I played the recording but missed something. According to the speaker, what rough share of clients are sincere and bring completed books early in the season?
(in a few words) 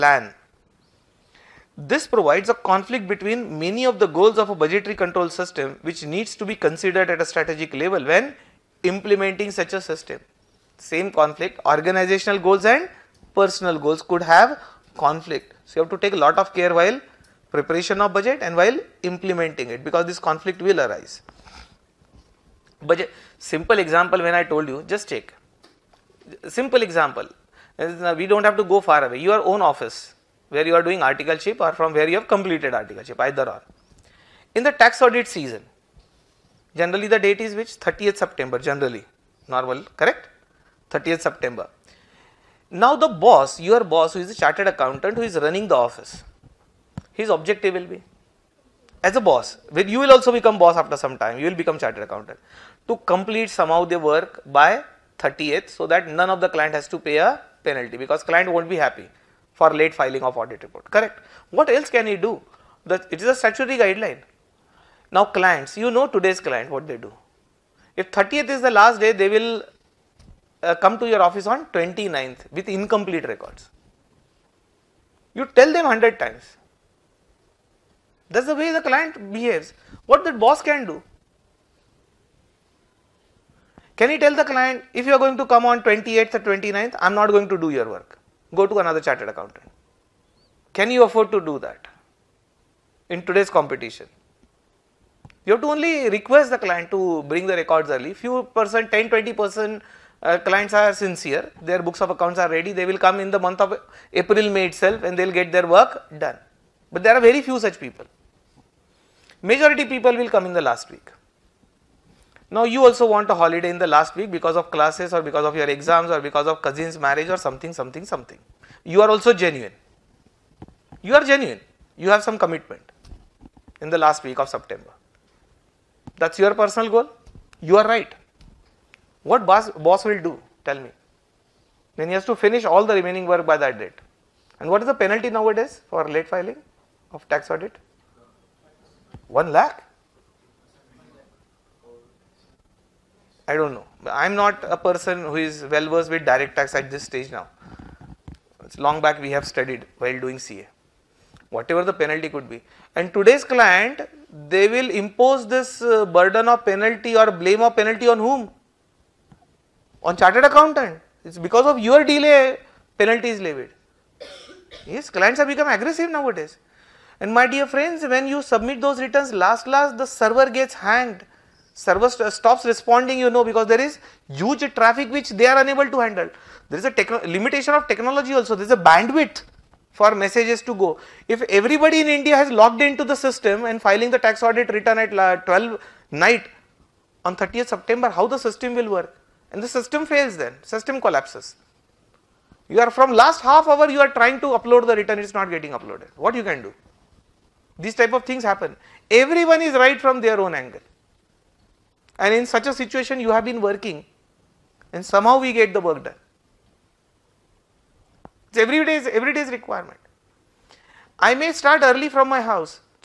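10 20 percent.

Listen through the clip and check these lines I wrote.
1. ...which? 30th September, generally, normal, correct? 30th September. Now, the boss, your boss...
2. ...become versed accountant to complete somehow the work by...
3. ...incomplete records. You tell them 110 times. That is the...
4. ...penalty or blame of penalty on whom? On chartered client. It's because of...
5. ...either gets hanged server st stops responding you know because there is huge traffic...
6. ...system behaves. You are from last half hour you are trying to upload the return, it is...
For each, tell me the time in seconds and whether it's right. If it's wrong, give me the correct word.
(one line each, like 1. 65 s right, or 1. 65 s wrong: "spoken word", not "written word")
1. 37 s right
2. 51 s wrong: "chartered", not "versed"
3. 72 s wrong: "100", not "110"
4. 156 s wrong: "accountant", not "client"
5. 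170 s wrong: "server", not "either"
6. 190 s wrong: "collapses", not "behaves".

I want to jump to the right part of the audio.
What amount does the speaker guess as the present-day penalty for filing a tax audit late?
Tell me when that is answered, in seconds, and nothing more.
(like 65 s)
139 s.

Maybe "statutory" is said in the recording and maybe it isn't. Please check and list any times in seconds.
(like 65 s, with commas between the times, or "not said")
63 s.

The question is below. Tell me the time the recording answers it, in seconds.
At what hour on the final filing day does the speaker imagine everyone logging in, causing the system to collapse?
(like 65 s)
185 s.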